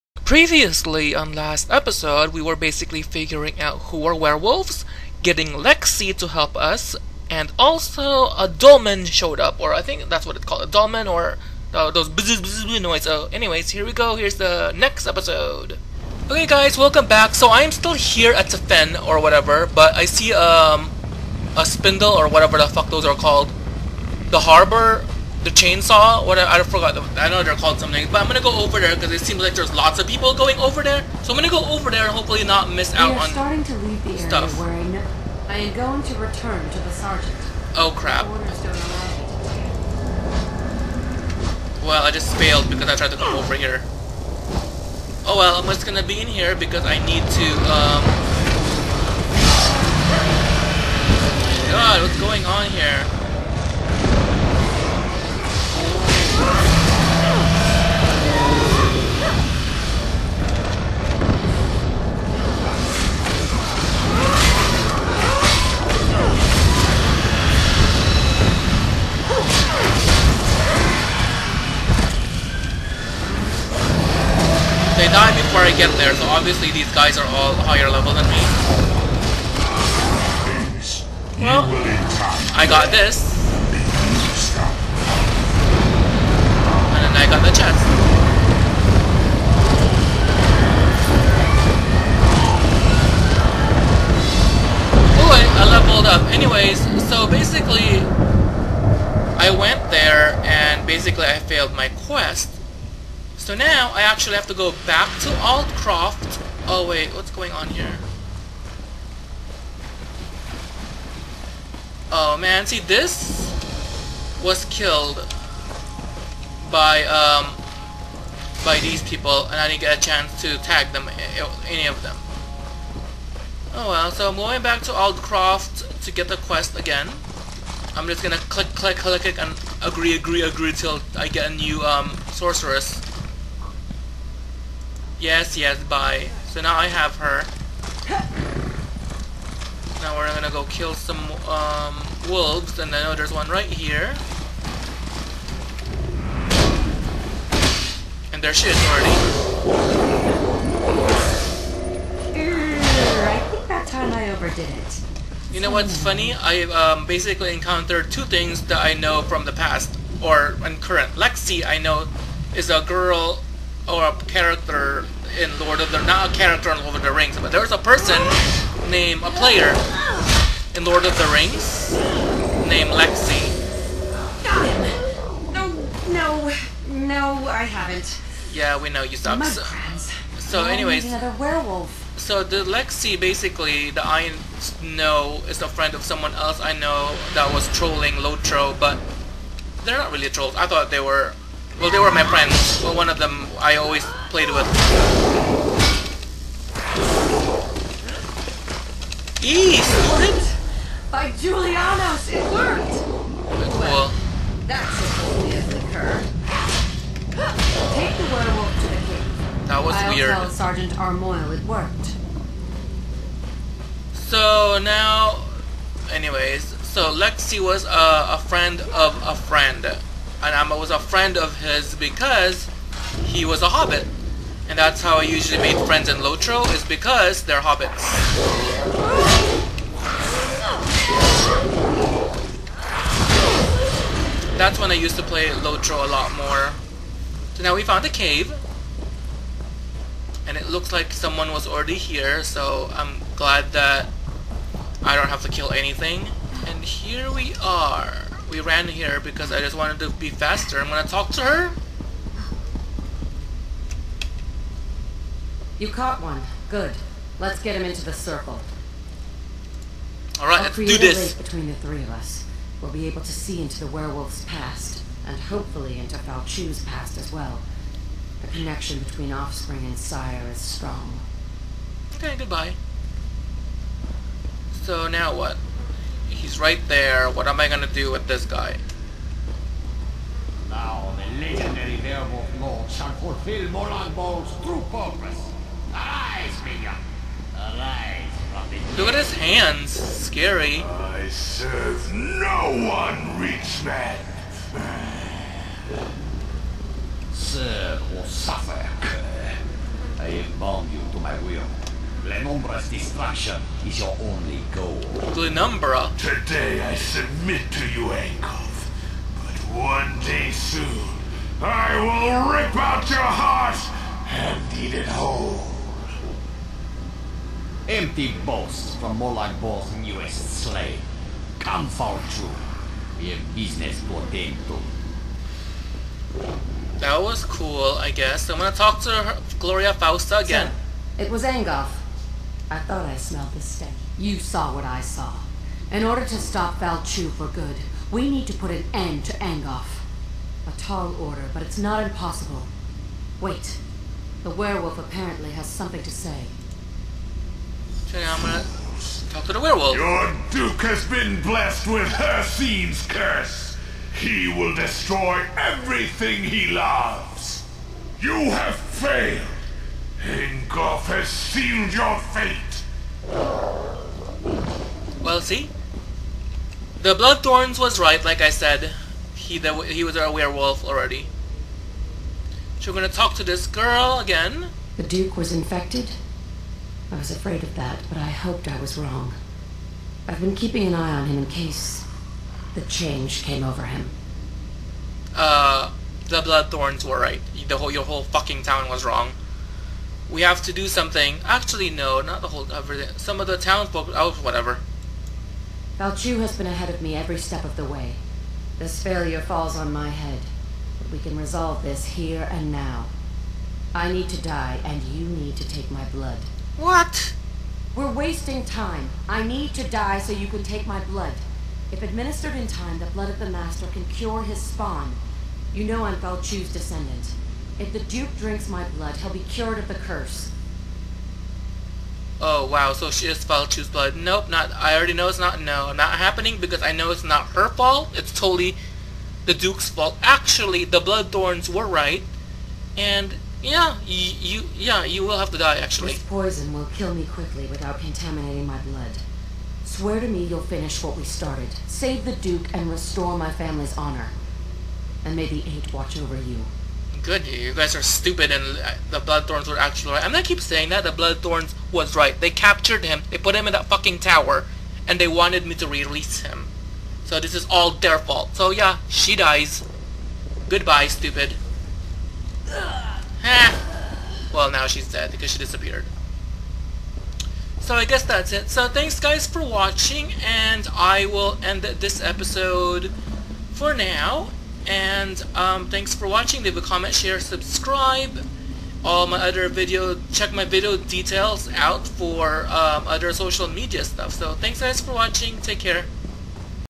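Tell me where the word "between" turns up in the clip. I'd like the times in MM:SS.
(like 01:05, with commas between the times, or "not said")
04:21, 04:28.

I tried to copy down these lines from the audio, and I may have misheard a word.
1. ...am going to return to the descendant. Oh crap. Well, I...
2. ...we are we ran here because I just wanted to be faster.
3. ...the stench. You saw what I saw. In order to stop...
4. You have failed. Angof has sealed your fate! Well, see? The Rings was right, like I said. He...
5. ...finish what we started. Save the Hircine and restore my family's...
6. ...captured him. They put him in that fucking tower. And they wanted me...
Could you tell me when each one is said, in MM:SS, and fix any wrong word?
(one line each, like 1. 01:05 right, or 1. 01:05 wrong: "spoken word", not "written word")
1. 00:35 wrong: "sergeant", not "descendant"
2. 04:07 right
3. 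05:33 right
4. 05:58 wrong: "Bloodthorns", not "Rings"
5. 07:20 wrong: "Duke", not "Hircine"
6. 07:32 right.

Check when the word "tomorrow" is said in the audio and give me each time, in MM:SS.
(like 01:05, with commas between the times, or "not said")
not said.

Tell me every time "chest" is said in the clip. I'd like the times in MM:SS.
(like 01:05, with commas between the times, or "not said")
01:27.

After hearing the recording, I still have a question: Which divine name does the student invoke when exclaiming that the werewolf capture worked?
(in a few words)
Julianos.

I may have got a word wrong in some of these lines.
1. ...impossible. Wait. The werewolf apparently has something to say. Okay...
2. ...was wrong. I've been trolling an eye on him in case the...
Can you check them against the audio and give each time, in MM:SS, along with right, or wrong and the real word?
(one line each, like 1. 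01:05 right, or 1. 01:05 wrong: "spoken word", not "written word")
1. 05:42 right
2. 06:18 wrong: "keeping", not "trolling".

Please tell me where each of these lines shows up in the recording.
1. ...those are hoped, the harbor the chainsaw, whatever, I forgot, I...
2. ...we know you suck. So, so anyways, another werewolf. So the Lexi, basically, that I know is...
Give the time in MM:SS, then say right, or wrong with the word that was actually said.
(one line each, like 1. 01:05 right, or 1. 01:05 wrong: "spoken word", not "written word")
1. 00:22 wrong: "called", not "hoped"
2. 02:58 right.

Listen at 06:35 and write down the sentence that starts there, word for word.
Faolchu has been ahead of me every step of the way.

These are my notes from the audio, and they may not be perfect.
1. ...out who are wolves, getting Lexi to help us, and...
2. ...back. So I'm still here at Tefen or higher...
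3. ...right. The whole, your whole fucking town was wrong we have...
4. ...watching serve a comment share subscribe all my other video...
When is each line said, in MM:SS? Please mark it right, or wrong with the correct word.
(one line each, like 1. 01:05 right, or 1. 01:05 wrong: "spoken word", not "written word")
1. 00:03 wrong: "werewolves", not "wolves"
2. 00:17 wrong: "whatever", not "higher"
3. 06:27 right
4. 07:56 wrong: "leave", not "serve".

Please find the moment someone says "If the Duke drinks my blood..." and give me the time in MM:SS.
06:57.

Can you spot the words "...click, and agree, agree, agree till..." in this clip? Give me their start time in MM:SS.
02:09.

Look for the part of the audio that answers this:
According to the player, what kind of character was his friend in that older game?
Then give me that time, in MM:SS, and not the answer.
03:43.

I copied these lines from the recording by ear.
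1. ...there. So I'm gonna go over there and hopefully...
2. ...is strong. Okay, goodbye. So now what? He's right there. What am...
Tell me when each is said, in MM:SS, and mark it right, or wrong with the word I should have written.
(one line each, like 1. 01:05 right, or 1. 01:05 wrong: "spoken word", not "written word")
1. 00:30 right
2. 04:30 right.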